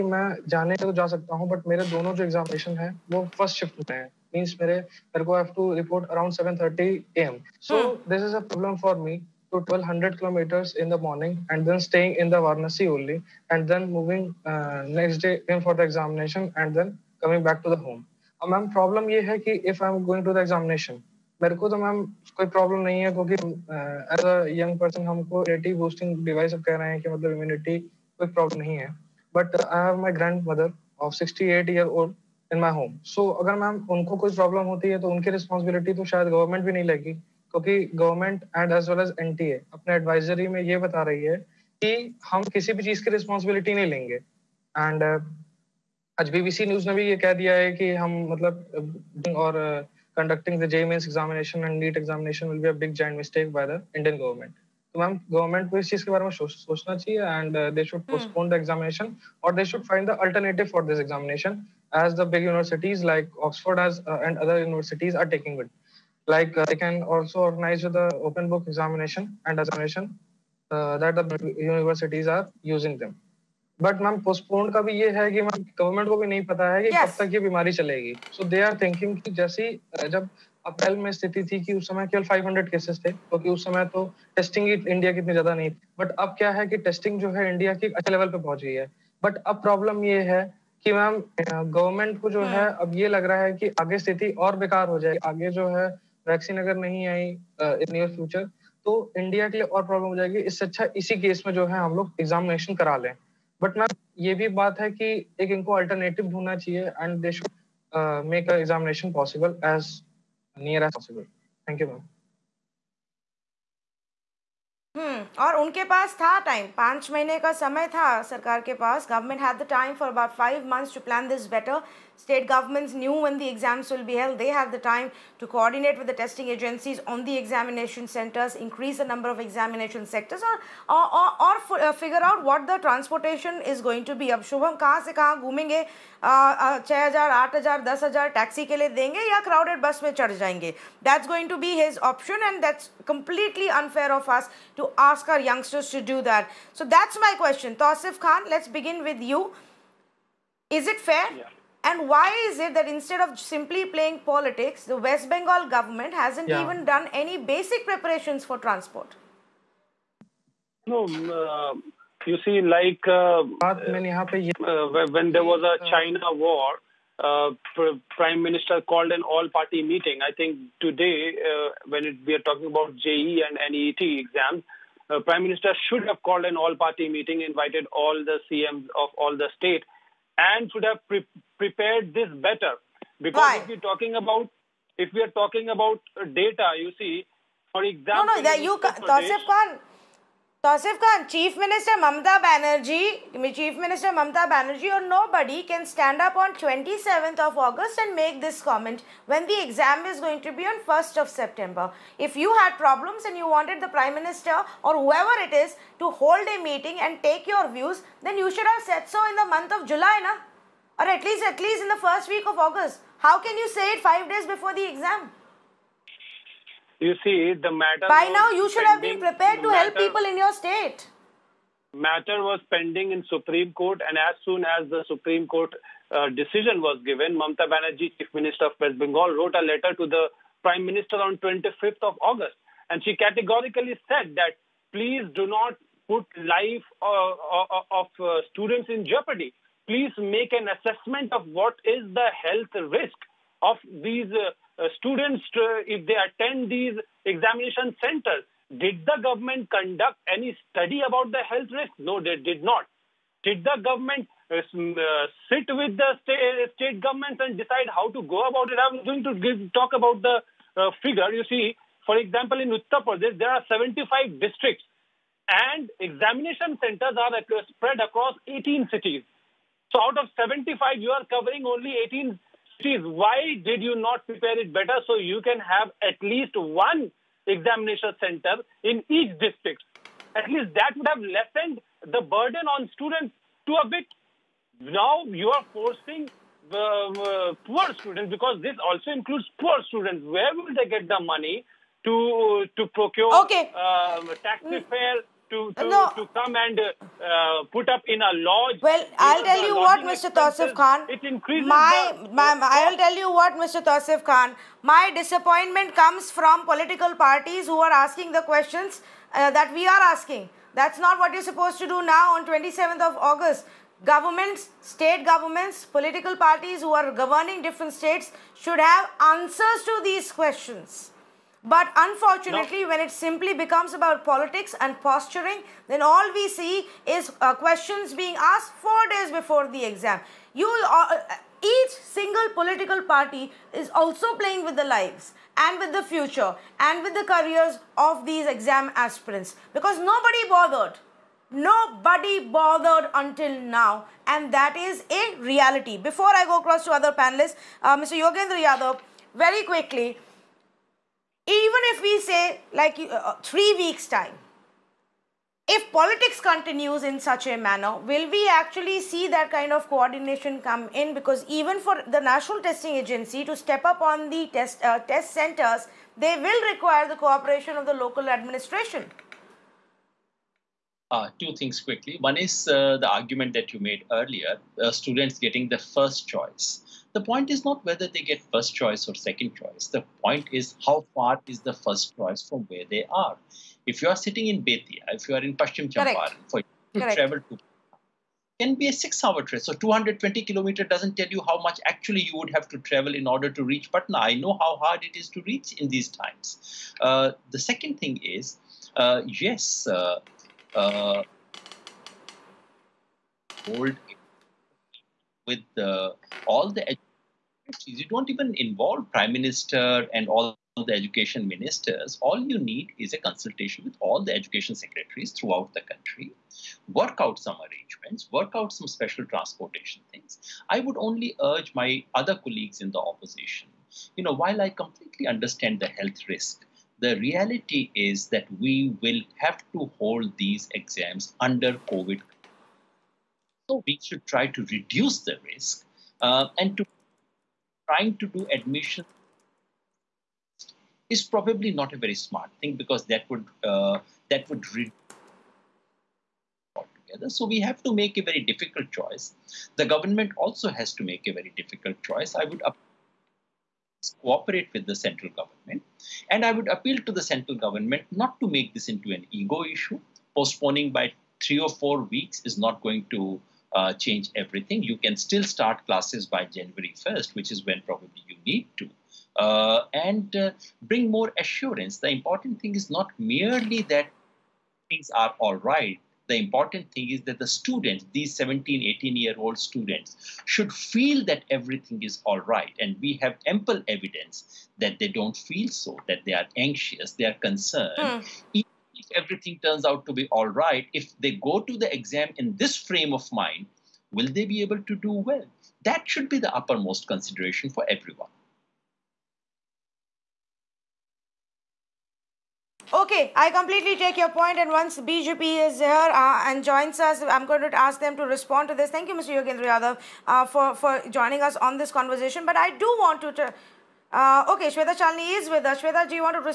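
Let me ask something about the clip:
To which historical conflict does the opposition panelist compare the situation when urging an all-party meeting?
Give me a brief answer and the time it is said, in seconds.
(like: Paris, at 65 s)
China war, at 165 s.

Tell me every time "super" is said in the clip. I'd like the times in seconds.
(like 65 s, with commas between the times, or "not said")
not said.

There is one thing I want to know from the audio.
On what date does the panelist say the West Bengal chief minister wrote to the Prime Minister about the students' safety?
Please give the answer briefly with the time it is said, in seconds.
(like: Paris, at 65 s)
25th of August, at 231 s.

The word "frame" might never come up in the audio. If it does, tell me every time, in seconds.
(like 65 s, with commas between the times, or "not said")
492 s.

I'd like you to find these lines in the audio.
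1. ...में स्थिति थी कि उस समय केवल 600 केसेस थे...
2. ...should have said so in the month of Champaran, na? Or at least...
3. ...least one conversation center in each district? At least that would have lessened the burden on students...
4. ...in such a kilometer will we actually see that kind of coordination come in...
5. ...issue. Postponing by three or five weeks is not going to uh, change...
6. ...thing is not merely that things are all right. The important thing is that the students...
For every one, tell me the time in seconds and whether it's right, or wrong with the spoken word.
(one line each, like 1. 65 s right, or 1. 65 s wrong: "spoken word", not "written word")
1. 81 s wrong: "500", not "600"
2. 208 s wrong: "July", not "Champaran"
3. 276 s wrong: "examination", not "conversation"
4. 357 s wrong: "manner", not "kilometer"
5. 459 s wrong: "four", not "five"
6. 472 s right.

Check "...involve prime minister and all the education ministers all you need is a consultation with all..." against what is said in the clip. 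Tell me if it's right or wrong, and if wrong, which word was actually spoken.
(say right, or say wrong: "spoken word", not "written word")
right.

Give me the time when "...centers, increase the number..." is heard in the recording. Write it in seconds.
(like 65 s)
128 s.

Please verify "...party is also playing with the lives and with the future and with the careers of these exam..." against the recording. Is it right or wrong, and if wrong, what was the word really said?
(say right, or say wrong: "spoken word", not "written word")
right.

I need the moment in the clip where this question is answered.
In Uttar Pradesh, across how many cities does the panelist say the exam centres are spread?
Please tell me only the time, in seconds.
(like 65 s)
268 s.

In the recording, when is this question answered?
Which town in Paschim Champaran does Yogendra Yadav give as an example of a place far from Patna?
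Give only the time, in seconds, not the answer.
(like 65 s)
384 s.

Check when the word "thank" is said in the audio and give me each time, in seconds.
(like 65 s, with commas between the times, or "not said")
111 s, 508 s.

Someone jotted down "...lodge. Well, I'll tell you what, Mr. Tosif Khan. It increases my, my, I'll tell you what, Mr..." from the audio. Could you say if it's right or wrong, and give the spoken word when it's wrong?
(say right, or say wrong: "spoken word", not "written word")
right.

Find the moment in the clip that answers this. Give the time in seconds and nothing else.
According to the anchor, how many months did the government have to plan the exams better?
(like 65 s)
120 s.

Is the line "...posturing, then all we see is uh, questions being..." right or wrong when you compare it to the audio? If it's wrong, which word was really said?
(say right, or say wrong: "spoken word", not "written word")
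right.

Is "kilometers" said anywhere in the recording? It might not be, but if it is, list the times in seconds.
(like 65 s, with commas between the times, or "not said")
10 s, 390 s.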